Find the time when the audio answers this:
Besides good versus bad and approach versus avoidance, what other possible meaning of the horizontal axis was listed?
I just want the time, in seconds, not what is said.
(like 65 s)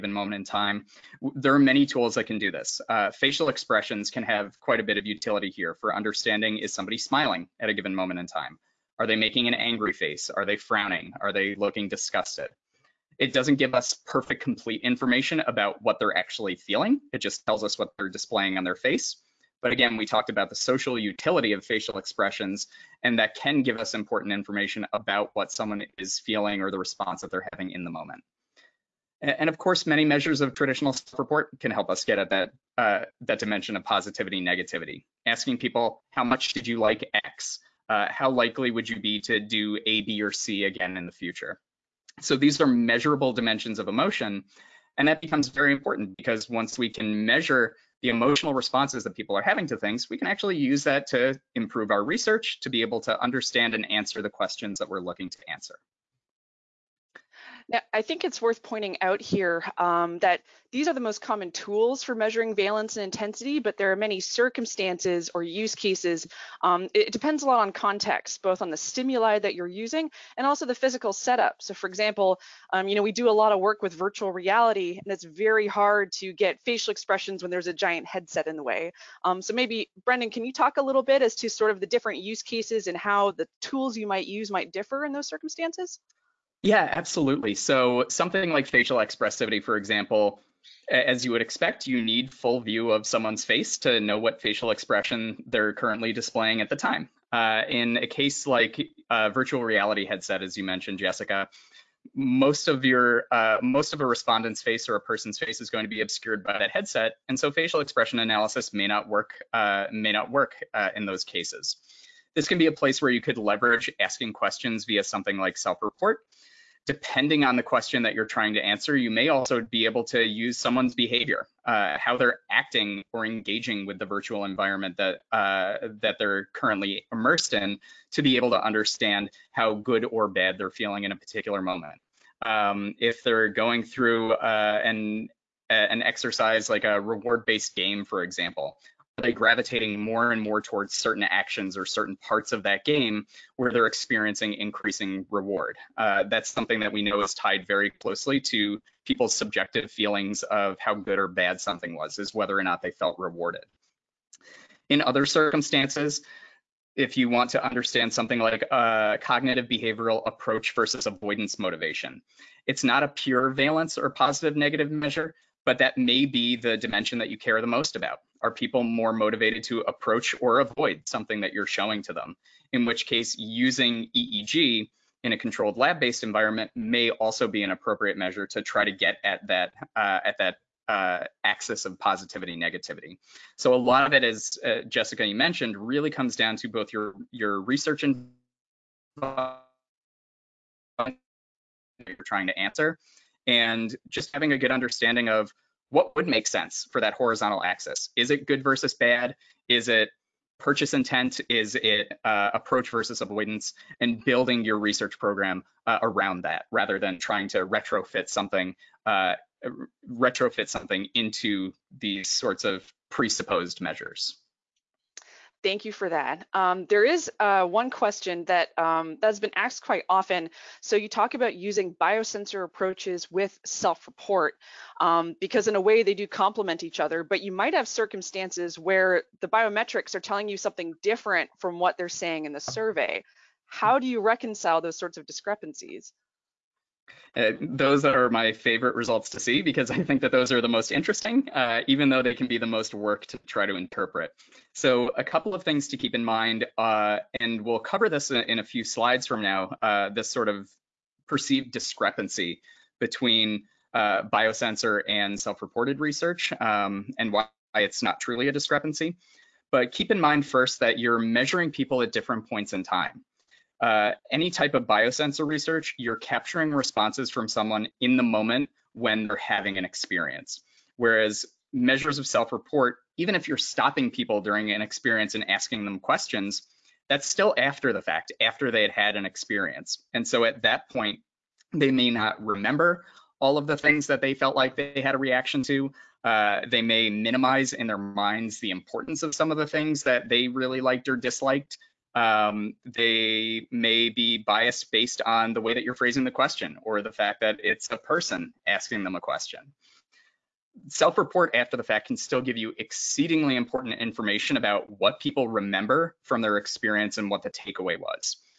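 200 s.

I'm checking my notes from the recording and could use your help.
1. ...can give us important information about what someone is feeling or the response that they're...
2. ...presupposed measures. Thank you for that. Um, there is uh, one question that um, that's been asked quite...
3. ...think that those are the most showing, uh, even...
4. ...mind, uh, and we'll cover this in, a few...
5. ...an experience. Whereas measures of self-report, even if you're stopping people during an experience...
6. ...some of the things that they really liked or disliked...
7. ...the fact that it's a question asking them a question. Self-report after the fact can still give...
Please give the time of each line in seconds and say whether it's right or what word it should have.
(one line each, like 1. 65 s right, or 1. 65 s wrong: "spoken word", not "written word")
1. 23 s right
2. 213 s right
3. 240 s wrong: "interesting", not "showing"
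4. 246 s right
5. 269 s right
6. 289 s right
7. 297 s wrong: "person", not "question".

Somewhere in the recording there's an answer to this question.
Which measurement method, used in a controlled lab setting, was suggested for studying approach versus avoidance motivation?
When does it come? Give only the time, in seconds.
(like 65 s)
174 s.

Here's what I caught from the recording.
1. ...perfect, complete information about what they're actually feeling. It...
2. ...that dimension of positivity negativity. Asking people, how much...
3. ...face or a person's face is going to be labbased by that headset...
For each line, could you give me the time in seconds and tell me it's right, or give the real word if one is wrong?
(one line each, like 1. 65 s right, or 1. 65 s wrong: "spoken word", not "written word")
1. 13 s right
2. 33 s right
3. 104 s wrong: "obscured", not "labbased".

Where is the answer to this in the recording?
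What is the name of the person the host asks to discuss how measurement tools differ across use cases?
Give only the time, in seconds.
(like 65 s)
80 s.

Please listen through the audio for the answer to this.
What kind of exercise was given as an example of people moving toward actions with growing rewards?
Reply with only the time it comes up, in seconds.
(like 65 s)
136 s.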